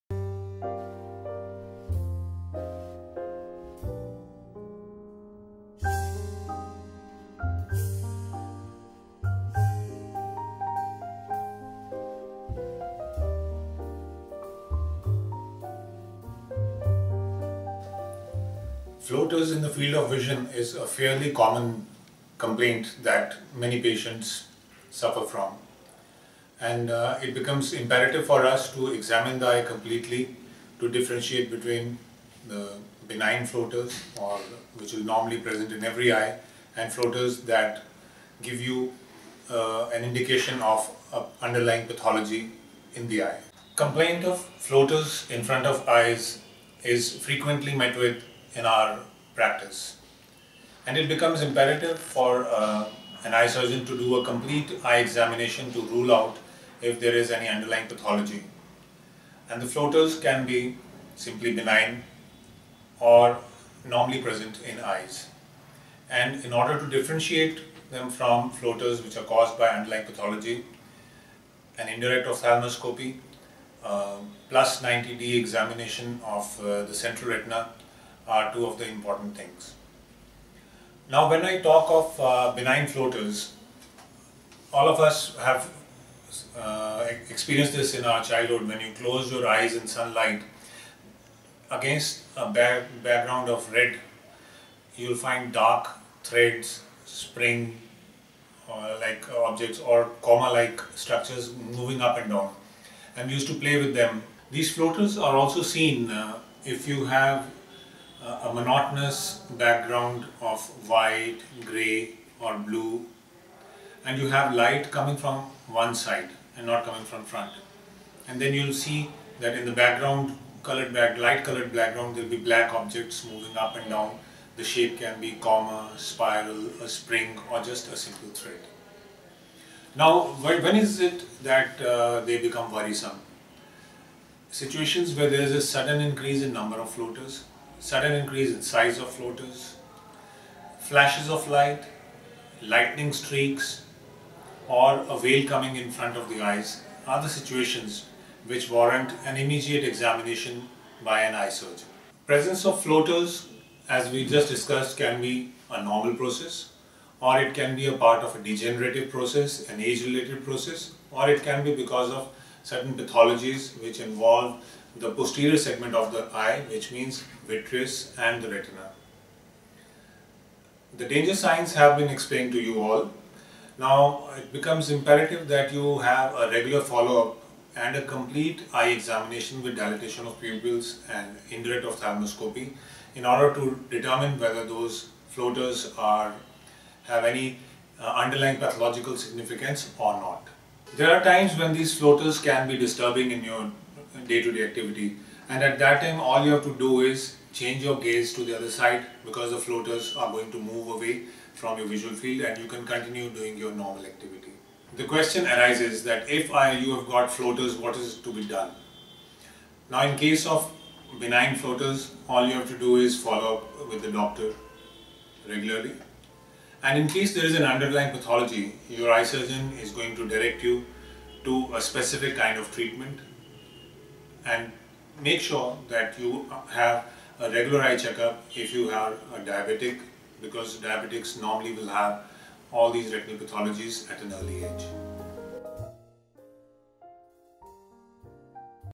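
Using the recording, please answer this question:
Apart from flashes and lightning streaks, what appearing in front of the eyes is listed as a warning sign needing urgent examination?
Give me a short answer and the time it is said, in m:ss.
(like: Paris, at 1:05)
a veil, at 2:25.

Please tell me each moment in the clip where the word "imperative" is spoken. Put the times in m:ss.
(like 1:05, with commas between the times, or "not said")
0:27, 0:51, 2:54.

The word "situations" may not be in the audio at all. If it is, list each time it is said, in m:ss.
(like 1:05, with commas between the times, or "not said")
2:14, 2:27.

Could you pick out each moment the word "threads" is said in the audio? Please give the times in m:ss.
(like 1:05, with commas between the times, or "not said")
1:36, 2:08.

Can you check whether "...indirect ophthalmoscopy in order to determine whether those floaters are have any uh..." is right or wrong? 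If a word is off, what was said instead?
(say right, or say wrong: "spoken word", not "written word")
right.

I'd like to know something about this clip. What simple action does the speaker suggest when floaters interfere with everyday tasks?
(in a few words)
change your gaze.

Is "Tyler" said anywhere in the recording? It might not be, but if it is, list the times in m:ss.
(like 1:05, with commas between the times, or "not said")
not said.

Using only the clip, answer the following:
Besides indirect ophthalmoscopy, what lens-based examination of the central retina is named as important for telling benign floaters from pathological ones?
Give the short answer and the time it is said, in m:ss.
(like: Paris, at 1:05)
+90D examination, at 1:14.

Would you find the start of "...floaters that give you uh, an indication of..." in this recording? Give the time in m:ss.
0:36.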